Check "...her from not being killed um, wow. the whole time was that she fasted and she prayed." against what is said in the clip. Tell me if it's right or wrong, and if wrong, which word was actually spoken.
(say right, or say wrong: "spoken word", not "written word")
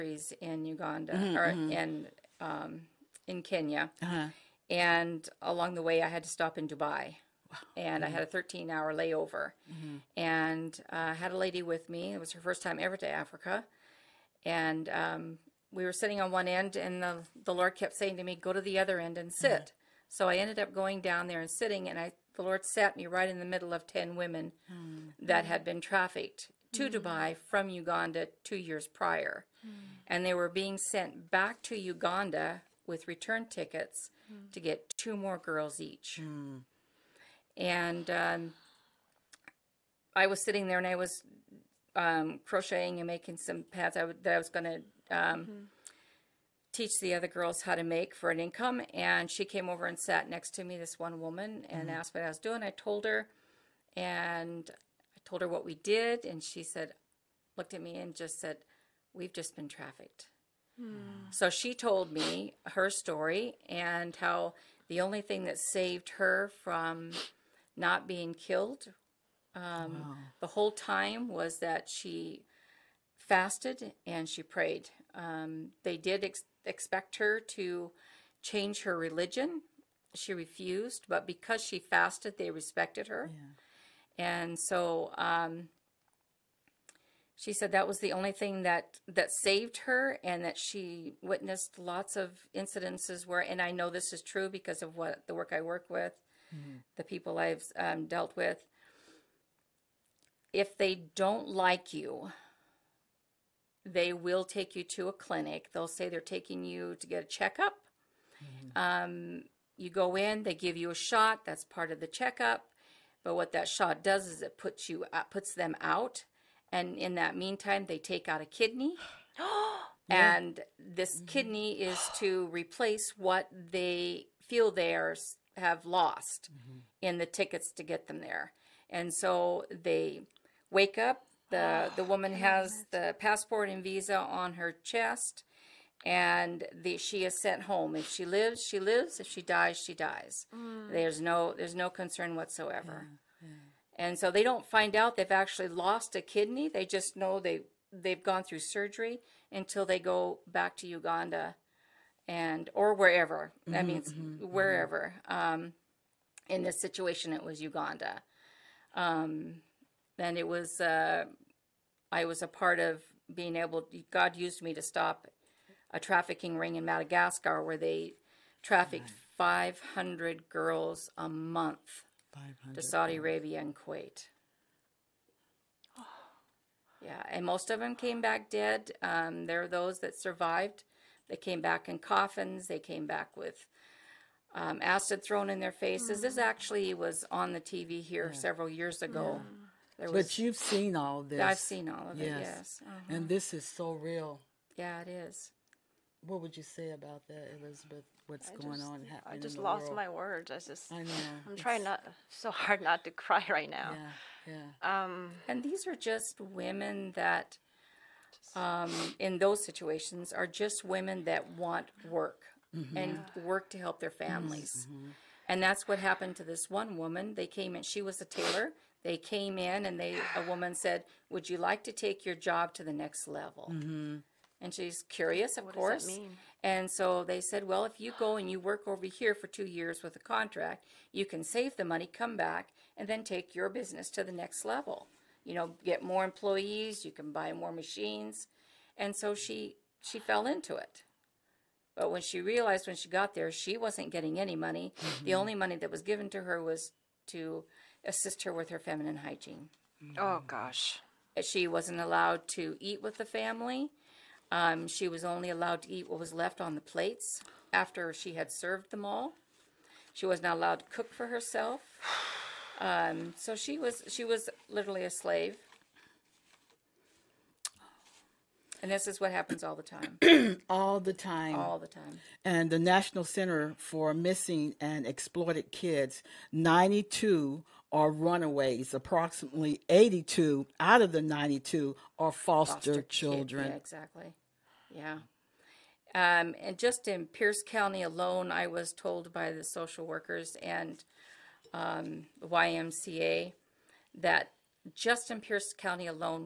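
right.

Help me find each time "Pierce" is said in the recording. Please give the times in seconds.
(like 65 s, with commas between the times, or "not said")
287 s, 295 s.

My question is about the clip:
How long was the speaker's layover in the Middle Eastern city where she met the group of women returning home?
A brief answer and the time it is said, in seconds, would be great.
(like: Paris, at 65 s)
13 hours, at 8 s.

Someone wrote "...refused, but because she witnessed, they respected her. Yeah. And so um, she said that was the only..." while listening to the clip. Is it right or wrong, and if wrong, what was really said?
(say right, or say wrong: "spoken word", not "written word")
wrong: "fasted", not "witnessed".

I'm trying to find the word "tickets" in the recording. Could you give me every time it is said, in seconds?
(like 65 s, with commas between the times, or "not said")
33 s, 127 s.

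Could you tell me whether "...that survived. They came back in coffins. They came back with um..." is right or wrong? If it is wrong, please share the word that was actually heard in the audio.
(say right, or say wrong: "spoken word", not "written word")
right.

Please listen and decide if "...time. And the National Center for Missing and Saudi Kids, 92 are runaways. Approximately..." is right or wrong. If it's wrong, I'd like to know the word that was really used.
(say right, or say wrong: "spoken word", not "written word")
wrong: "Exploited", not "Saudi".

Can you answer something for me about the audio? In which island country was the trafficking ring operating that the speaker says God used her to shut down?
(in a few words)
Madagascar.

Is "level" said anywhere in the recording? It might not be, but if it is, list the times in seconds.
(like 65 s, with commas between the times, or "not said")
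223 s, 234 s.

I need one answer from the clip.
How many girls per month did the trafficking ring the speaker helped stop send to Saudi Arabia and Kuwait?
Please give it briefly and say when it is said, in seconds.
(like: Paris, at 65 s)
500, at 169 s.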